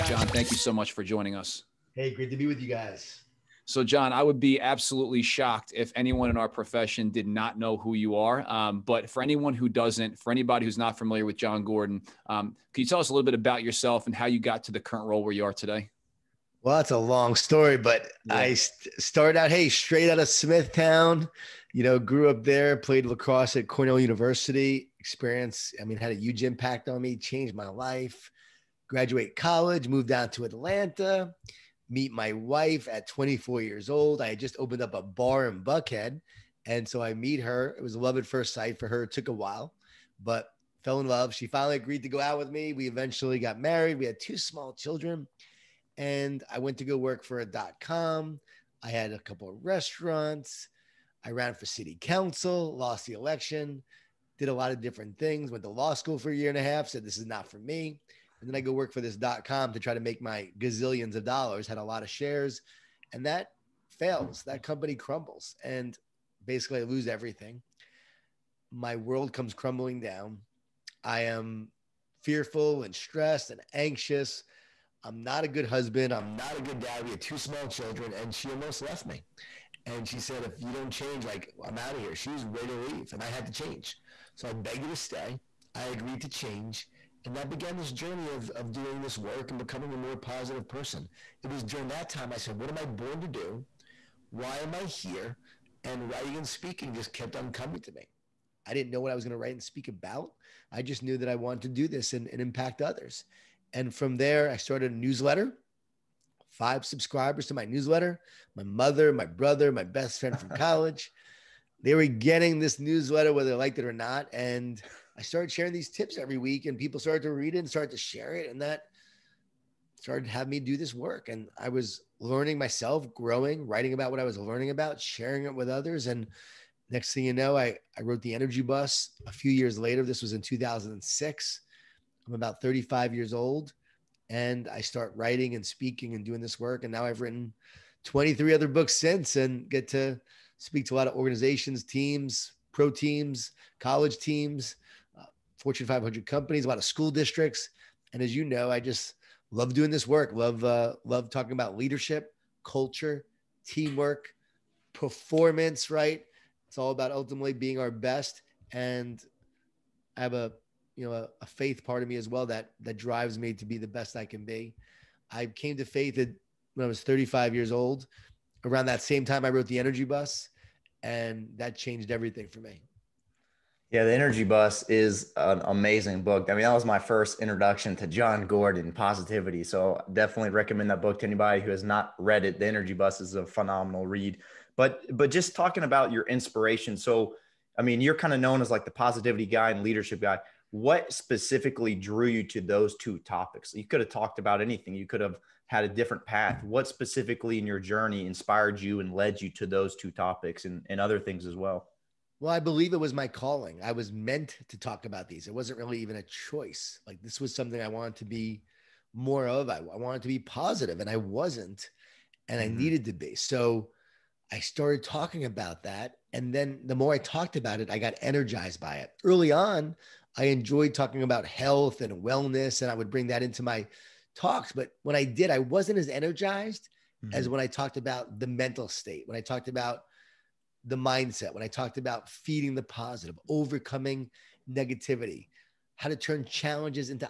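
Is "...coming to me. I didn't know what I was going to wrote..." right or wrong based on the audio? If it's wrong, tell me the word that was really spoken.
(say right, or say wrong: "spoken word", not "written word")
wrong: "write", not "wrote".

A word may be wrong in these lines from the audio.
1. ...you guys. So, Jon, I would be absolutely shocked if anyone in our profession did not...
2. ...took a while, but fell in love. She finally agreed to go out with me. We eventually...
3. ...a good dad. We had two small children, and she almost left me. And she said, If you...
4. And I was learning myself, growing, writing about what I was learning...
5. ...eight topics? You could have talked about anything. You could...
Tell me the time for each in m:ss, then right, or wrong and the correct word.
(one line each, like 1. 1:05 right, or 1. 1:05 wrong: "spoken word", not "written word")
1. 0:02 right
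2. 0:39 right
3. 1:16 right
4. 2:01 right
5. 3:12 wrong: "two", not "eight".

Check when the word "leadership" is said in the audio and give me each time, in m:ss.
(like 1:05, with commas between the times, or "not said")
2:31, 3:09.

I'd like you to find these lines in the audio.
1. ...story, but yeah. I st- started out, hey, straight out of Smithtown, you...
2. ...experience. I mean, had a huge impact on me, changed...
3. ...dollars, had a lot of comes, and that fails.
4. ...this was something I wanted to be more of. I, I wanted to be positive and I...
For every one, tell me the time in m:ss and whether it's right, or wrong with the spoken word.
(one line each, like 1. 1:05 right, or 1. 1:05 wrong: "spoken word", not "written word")
1. 0:17 right
2. 0:25 right
3. 1:01 wrong: "shares", not "comes"
4. 3:27 right.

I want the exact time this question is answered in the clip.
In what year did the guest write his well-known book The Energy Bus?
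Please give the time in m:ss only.
2:10.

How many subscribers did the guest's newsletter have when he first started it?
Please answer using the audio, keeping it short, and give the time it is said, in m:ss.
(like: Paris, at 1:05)
5, at 1:46.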